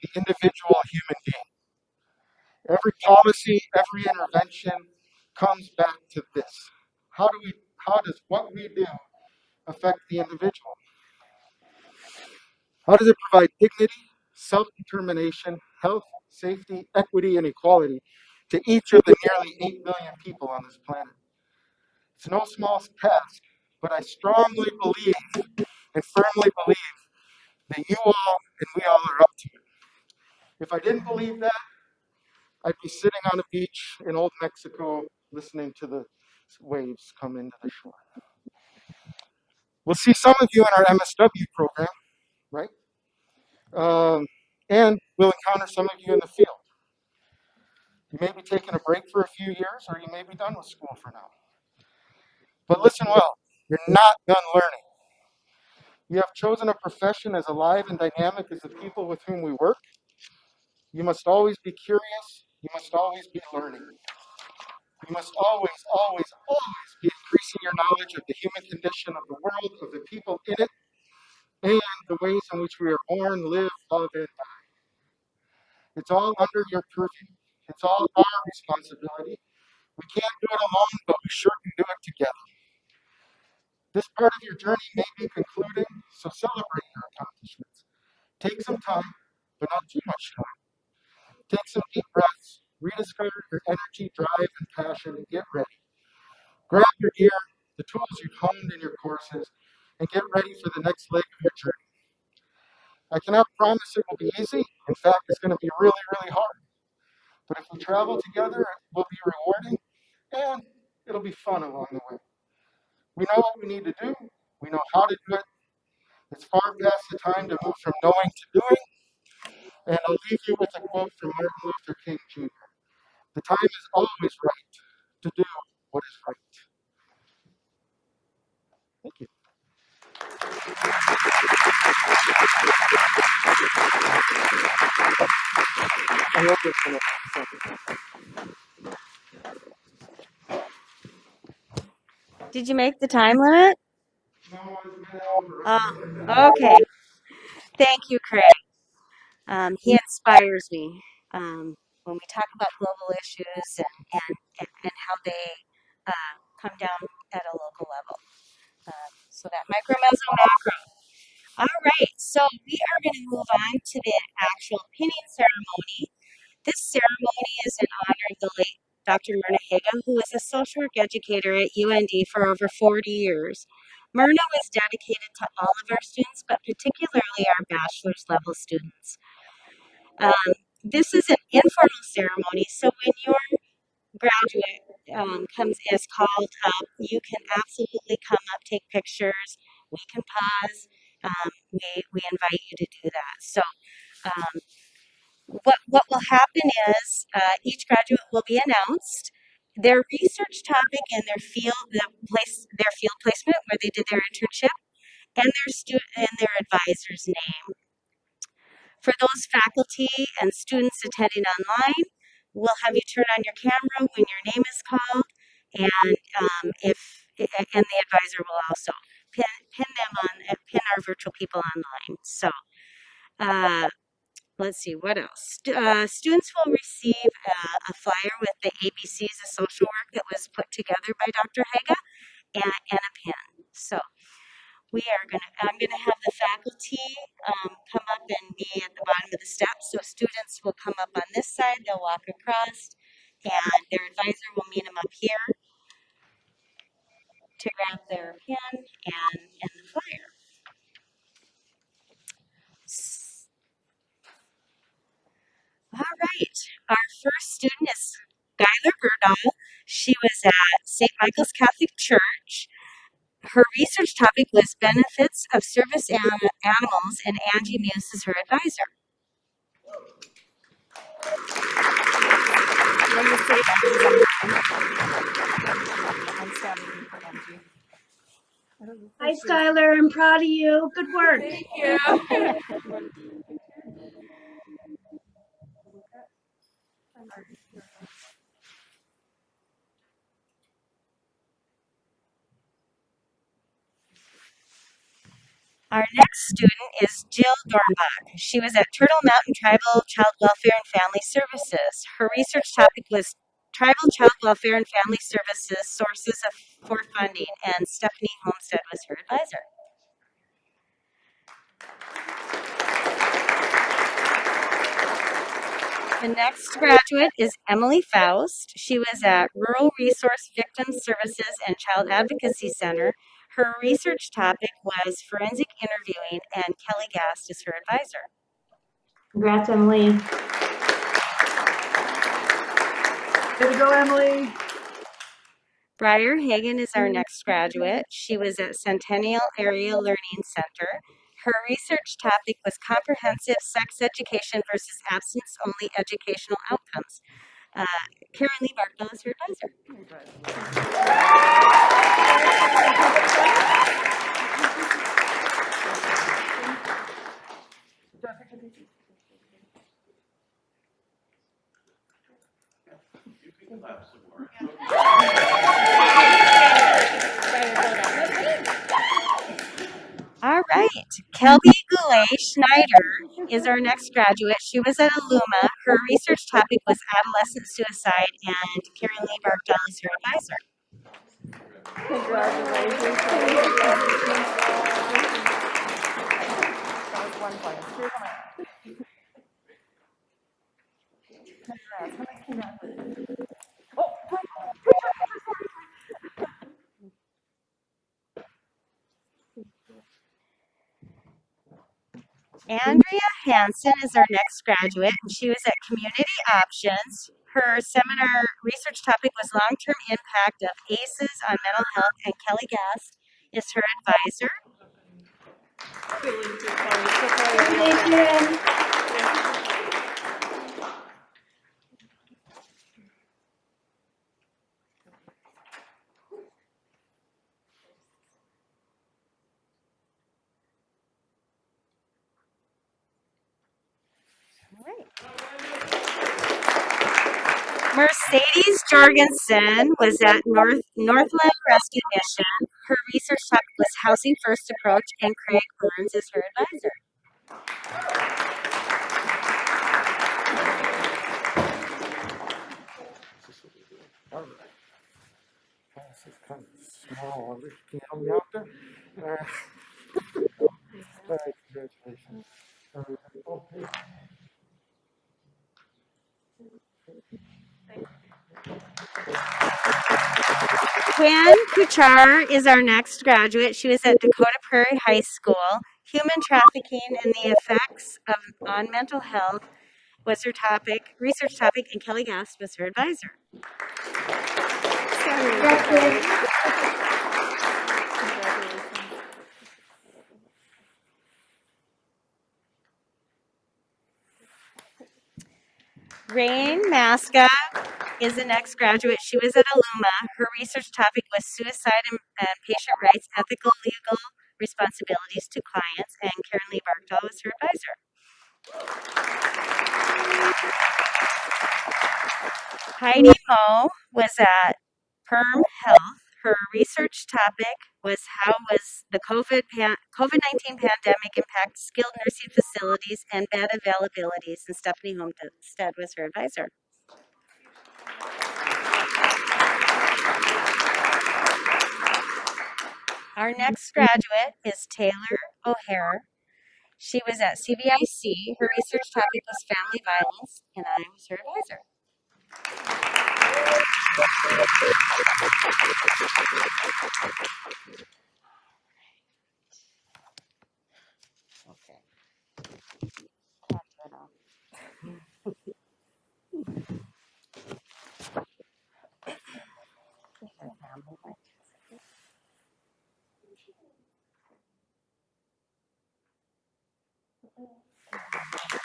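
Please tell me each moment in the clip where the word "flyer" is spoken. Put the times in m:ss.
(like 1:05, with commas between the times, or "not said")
3:47, 4:09.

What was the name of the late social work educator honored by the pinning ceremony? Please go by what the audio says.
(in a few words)
Myrna Haga.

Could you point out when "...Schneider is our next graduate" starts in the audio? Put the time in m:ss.
6:12.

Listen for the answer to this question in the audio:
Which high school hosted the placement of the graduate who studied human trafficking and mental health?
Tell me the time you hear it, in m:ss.
7:54.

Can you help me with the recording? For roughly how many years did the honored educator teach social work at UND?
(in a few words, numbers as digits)
40.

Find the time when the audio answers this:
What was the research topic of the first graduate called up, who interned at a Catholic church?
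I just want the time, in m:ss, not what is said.
4:24.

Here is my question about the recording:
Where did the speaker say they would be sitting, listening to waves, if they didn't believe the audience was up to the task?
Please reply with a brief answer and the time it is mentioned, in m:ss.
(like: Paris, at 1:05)
A beach in old Mexico, at 0:33.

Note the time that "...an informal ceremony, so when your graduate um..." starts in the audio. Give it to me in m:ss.
3:01.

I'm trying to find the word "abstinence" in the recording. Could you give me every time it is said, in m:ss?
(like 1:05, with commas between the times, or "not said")
5:45.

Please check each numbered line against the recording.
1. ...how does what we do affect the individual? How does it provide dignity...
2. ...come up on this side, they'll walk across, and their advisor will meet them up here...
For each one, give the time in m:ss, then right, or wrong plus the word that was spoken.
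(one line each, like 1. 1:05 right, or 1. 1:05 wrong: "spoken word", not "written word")
1. 0:07 right
2. 4:00 right.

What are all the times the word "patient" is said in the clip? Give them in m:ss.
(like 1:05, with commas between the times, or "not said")
8:22.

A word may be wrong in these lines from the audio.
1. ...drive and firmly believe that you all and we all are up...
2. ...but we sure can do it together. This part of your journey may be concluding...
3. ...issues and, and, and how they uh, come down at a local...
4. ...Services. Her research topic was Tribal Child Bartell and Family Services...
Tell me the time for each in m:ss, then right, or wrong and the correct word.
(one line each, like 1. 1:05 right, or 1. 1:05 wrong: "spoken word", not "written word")
1. 0:24 wrong: "believe", not "drive"
2. 1:21 right
3. 2:33 right
4. 5:01 wrong: "Welfare", not "Bartell".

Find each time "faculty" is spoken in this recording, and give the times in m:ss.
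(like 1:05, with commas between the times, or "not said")
3:29, 3:56.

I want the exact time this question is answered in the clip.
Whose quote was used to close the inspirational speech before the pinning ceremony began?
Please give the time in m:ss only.
2:01.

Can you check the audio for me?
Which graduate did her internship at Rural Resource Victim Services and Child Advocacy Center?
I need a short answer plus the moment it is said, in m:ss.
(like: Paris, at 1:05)
Emily Faust, at 5:17.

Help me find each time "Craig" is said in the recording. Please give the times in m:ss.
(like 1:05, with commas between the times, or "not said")
2:28, 7:25.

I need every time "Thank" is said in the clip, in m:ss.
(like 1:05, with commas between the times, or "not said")
2:09, 2:27, 4:41, 6:56.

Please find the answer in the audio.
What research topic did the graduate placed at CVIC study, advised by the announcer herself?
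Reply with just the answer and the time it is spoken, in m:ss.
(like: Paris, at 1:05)
Family violence, at 8:59.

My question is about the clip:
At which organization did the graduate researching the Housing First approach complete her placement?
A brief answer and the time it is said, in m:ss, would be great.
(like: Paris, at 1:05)
Northland Rescue Mission, at 7:20.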